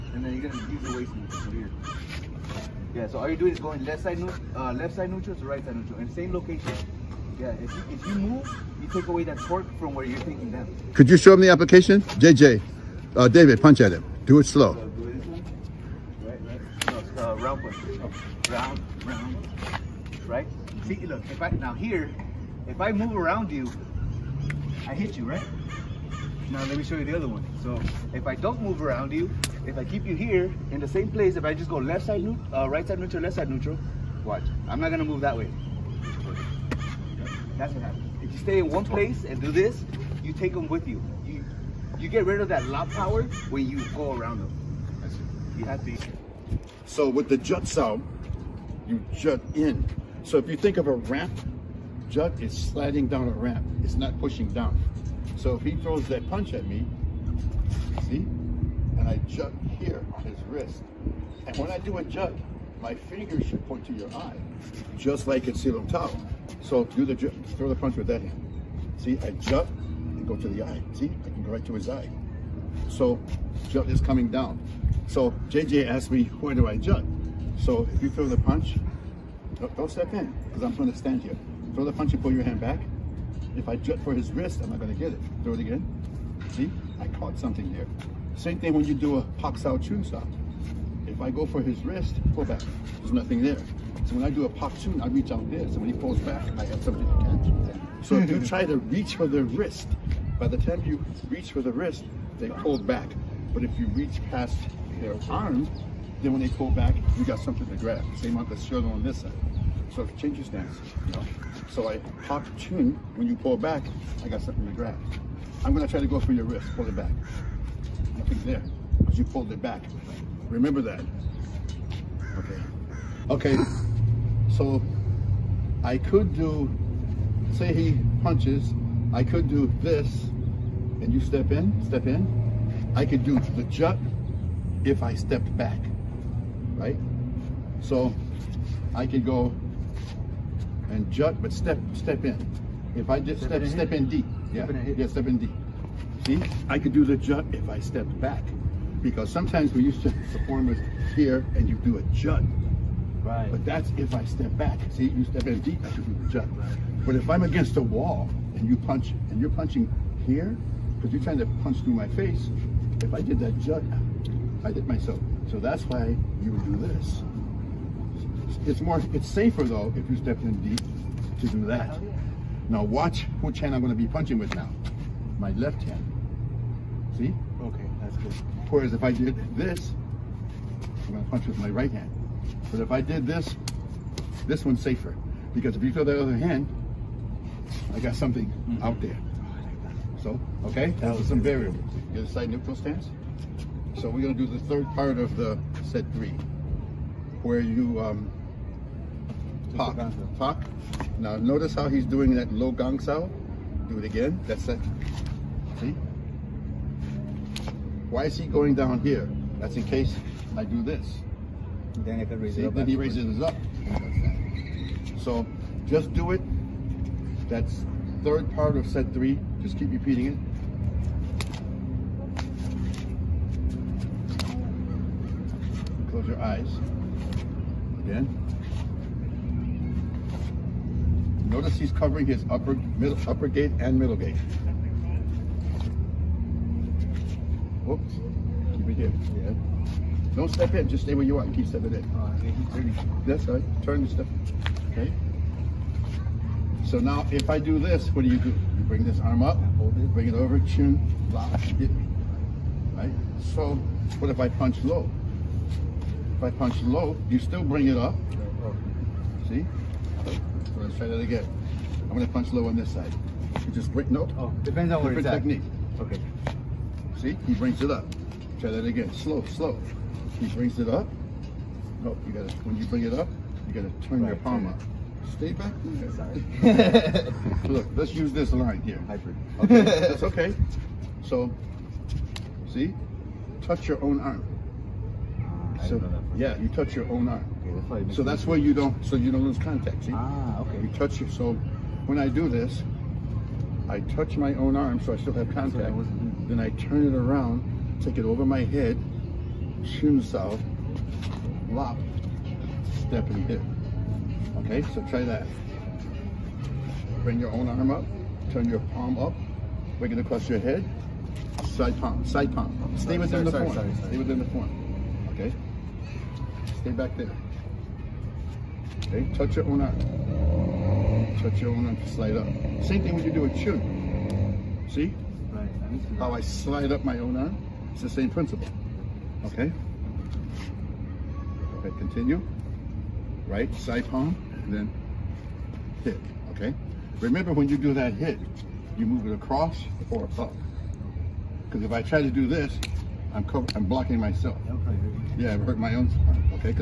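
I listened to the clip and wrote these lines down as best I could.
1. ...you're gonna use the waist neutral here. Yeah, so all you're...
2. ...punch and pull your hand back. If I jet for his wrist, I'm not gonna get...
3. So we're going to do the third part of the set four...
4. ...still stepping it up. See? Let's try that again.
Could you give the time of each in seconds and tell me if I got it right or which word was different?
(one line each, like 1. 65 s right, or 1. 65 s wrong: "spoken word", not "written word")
1. 0 s right
2. 81 s right
3. 194 s wrong: "three", not "four"
4. 257 s wrong: "bring", not "stepping".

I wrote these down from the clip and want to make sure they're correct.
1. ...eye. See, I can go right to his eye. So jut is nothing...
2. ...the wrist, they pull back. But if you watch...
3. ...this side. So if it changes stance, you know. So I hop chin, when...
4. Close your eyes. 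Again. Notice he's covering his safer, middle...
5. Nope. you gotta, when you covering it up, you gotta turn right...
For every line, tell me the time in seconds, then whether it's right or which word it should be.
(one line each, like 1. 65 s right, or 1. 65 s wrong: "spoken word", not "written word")
1. 70 s wrong: "coming", not "nothing"
2. 101 s wrong: "reach", not "watch"
3. 109 s right
4. 226 s wrong: "upper", not "safer"
5. 272 s wrong: "bring", not "covering".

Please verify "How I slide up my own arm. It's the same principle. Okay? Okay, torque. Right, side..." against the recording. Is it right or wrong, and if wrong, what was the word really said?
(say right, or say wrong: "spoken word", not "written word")
wrong: "continue", not "torque".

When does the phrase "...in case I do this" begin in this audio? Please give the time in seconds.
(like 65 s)
209 s.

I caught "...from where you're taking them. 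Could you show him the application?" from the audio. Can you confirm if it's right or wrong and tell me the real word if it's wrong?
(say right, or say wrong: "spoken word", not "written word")
right.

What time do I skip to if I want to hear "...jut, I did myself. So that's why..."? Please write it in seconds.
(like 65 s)
163 s.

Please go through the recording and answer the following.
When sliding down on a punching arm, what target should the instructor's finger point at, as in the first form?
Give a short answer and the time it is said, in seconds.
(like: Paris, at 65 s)
the eye, at 63 s.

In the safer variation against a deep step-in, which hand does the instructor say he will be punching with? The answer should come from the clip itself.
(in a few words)
Left hand.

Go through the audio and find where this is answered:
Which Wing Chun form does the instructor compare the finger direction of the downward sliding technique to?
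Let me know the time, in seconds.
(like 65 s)
65 s.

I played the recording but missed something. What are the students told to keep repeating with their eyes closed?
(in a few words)
Third part of set three.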